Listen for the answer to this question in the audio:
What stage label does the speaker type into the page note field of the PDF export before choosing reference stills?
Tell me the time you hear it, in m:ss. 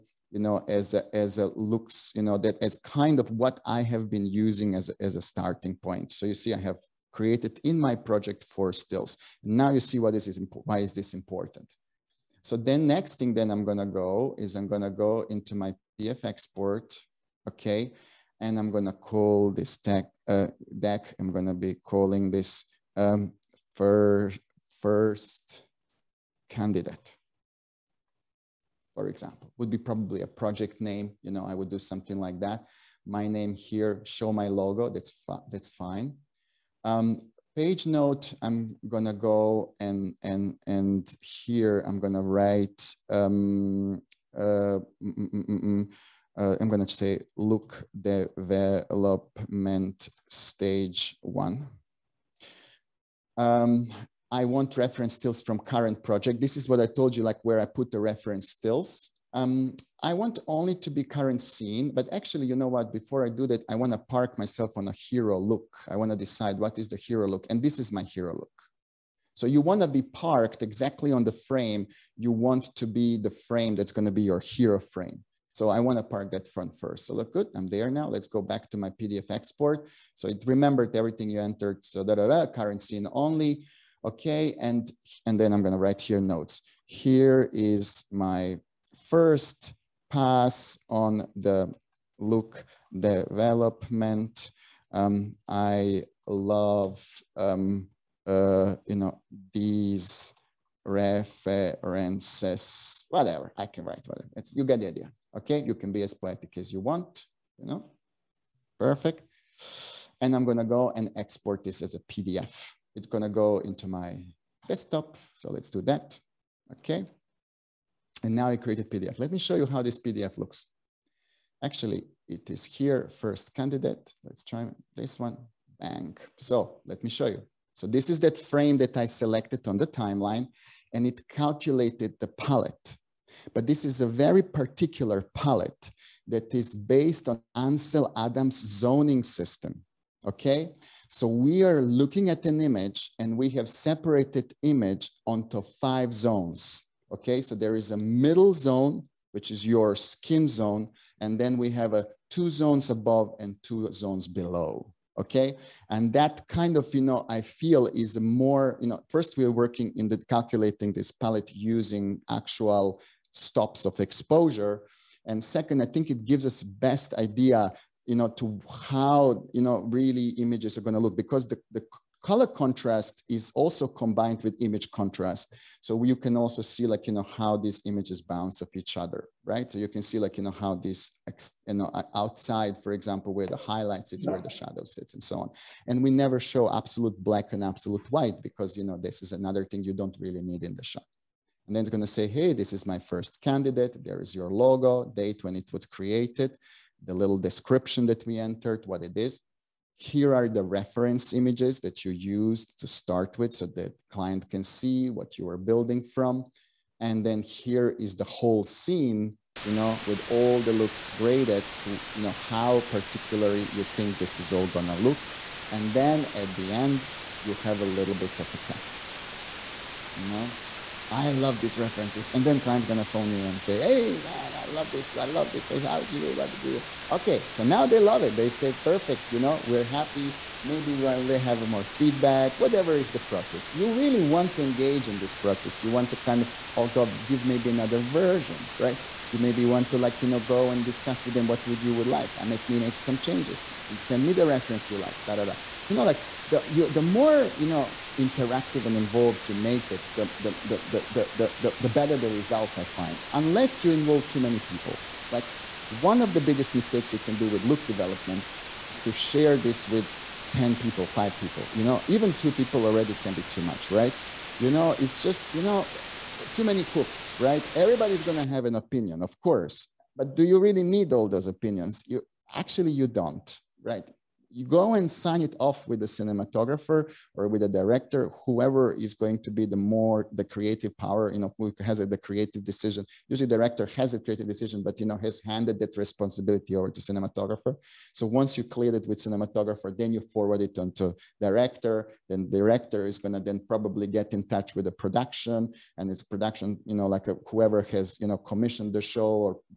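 0:47.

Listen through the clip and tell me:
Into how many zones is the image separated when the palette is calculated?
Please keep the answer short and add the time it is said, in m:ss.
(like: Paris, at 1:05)
5, at 2:25.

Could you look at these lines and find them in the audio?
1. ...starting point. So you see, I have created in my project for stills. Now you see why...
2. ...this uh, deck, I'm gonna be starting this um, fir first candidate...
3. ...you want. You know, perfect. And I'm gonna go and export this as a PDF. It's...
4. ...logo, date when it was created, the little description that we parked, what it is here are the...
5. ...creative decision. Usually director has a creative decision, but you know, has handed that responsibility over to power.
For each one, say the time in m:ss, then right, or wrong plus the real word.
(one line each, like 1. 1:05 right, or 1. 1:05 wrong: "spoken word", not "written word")
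1. 0:05 right
2. 0:19 wrong: "calling", not "starting"
3. 1:46 right
4. 3:14 wrong: "entered", not "parked"
5. 4:42 wrong: "cinematographer", not "power".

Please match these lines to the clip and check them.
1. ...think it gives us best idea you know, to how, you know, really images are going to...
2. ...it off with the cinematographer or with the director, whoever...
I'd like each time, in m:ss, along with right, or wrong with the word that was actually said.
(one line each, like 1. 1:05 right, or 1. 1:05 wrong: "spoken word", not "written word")
1. 2:45 right
2. 4:35 right.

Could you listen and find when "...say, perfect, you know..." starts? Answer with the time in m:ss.
3:48.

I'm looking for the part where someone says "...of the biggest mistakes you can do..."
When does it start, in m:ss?
4:16.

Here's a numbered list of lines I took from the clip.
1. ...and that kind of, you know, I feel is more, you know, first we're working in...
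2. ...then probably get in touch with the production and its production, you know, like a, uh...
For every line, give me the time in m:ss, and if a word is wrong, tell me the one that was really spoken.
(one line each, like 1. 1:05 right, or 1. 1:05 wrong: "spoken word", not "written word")
1. 2:35 right
2. 4:53 right.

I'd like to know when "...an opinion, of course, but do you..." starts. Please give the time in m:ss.
4:28.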